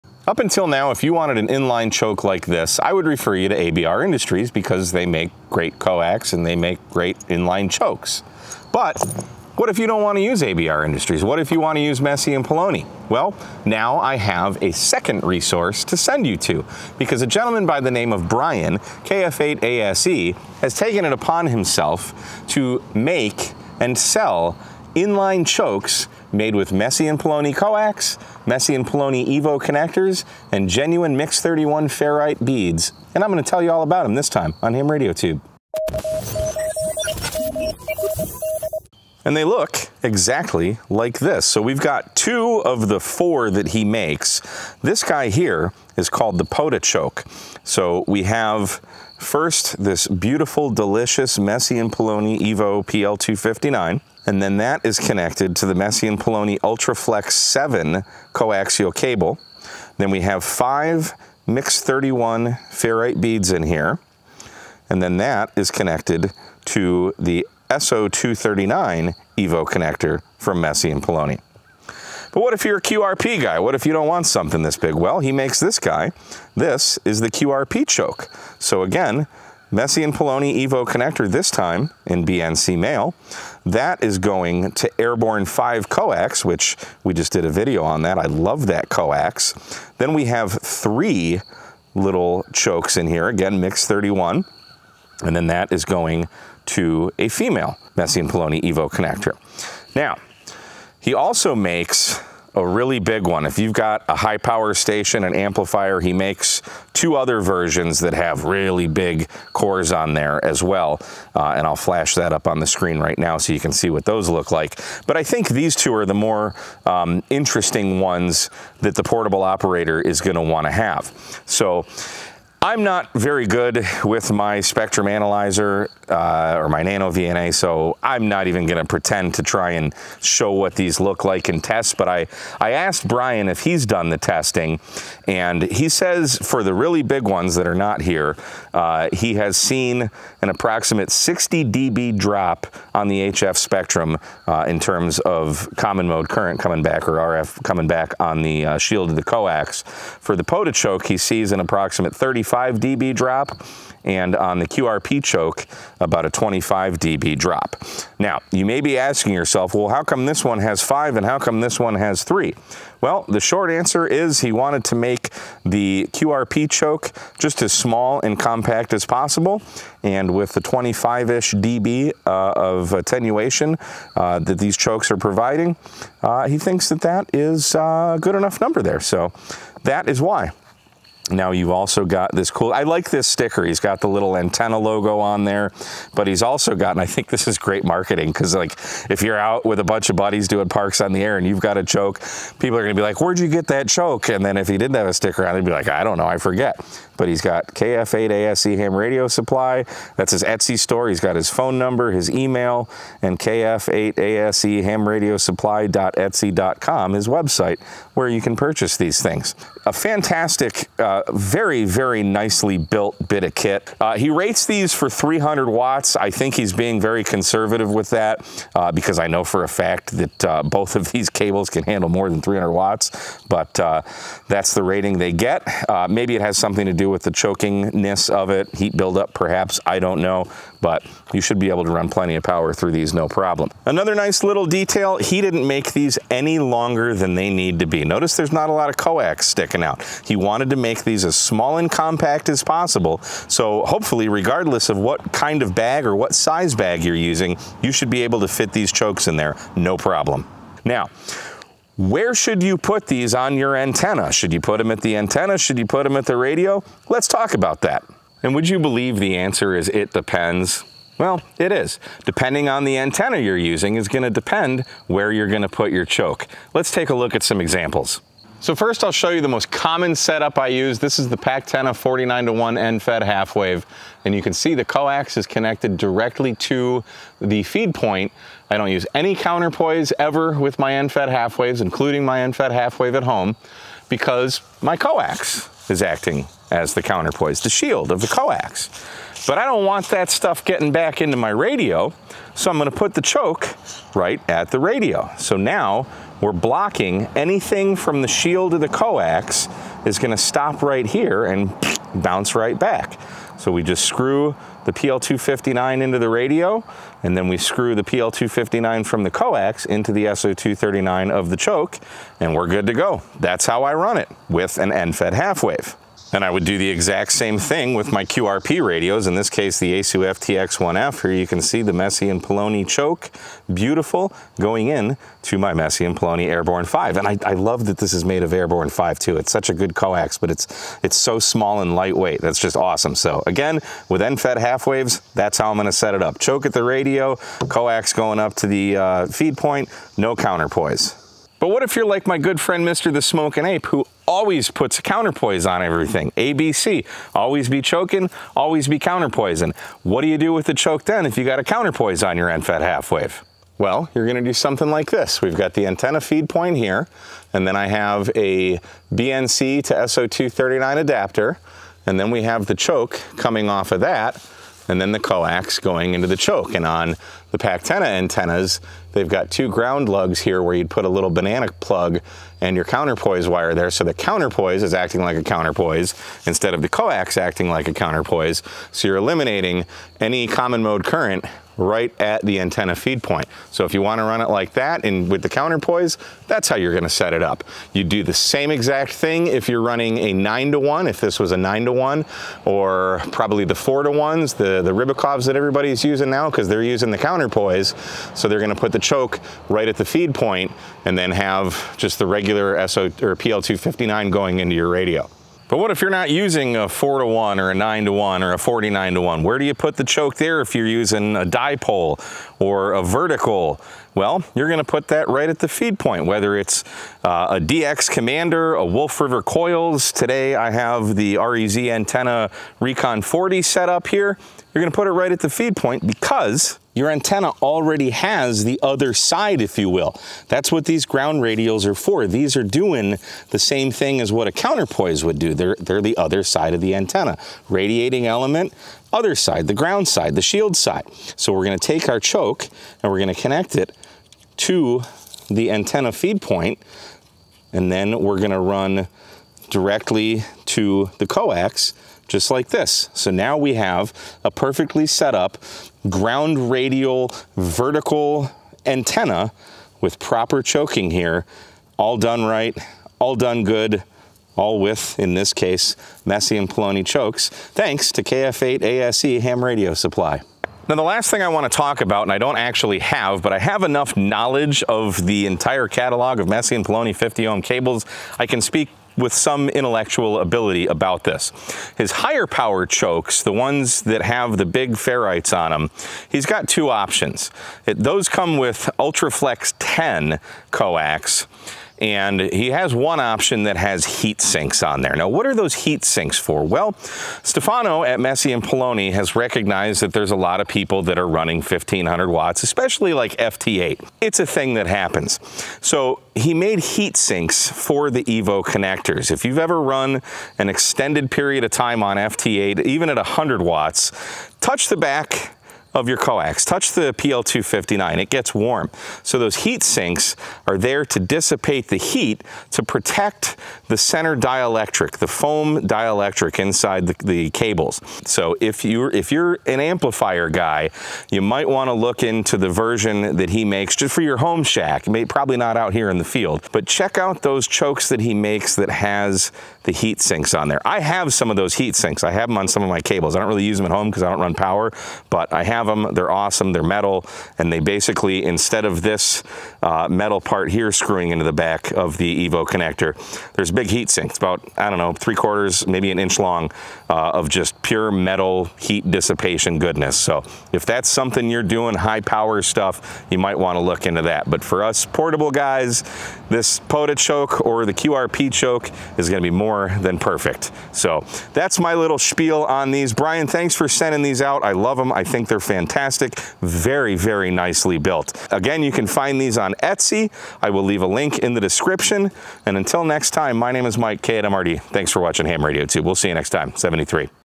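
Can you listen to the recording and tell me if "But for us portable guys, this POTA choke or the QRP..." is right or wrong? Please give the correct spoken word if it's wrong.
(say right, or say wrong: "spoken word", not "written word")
right.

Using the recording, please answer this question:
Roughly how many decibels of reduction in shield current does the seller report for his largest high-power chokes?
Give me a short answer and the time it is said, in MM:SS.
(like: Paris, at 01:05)
60 dB, at 02:21.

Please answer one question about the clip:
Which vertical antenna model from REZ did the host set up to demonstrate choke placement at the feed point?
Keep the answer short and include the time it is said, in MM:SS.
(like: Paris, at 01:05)
Recon 40, at 07:02.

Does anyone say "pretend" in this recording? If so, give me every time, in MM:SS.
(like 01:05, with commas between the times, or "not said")
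02:08.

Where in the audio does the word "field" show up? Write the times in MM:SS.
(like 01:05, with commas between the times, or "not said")
08:56.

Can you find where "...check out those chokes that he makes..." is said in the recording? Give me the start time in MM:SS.
08:56.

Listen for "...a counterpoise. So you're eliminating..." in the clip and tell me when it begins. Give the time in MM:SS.
06:17.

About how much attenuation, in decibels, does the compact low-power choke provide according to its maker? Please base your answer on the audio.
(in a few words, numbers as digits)
25 dB.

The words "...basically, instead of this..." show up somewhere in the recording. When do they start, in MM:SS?
09:07.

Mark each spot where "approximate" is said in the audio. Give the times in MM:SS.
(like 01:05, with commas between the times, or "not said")
02:20, 02:31.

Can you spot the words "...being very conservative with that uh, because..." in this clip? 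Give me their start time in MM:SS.
03:36.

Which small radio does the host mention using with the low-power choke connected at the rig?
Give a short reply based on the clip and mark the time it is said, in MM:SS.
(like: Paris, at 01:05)
Yaesu FTX1F, at 05:19.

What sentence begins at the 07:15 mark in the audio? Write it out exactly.
They're, they're the other side of the antenna.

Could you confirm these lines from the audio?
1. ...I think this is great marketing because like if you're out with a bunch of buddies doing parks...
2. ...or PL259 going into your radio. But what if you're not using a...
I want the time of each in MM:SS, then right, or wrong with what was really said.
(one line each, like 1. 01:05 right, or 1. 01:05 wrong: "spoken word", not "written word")
1. 03:07 right
2. 06:43 right.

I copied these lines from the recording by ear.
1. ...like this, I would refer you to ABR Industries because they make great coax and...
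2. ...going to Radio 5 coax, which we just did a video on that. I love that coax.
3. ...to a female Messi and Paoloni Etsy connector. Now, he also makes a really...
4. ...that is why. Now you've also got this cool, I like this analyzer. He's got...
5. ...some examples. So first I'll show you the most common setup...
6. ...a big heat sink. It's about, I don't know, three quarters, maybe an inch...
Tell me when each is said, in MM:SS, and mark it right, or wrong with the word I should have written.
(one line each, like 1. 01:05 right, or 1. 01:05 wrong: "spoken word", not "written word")
1. 00:02 right
2. 01:24 wrong: "Airborne", not "Radio"
3. 01:36 wrong: "Evo", not "Etsy"
4. 02:59 wrong: "sticker", not "analyzer"
5. 04:27 right
6. 09:13 right.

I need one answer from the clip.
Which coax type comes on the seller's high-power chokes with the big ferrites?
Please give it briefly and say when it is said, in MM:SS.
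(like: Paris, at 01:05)
UltraFlex 10, at 08:08.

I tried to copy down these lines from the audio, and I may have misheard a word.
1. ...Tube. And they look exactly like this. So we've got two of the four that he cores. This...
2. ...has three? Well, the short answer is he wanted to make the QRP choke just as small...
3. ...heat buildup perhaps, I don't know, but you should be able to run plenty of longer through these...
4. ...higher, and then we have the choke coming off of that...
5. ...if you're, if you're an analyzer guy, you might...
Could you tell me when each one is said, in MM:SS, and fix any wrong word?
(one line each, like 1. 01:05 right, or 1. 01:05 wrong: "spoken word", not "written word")
1. 00:35 wrong: "makes", not "cores"
2. 02:41 right
3. 03:48 wrong: "power", not "longer"
4. 06:00 wrong: "adapter", not "higher"
5. 08:48 wrong: "amplifier", not "analyzer".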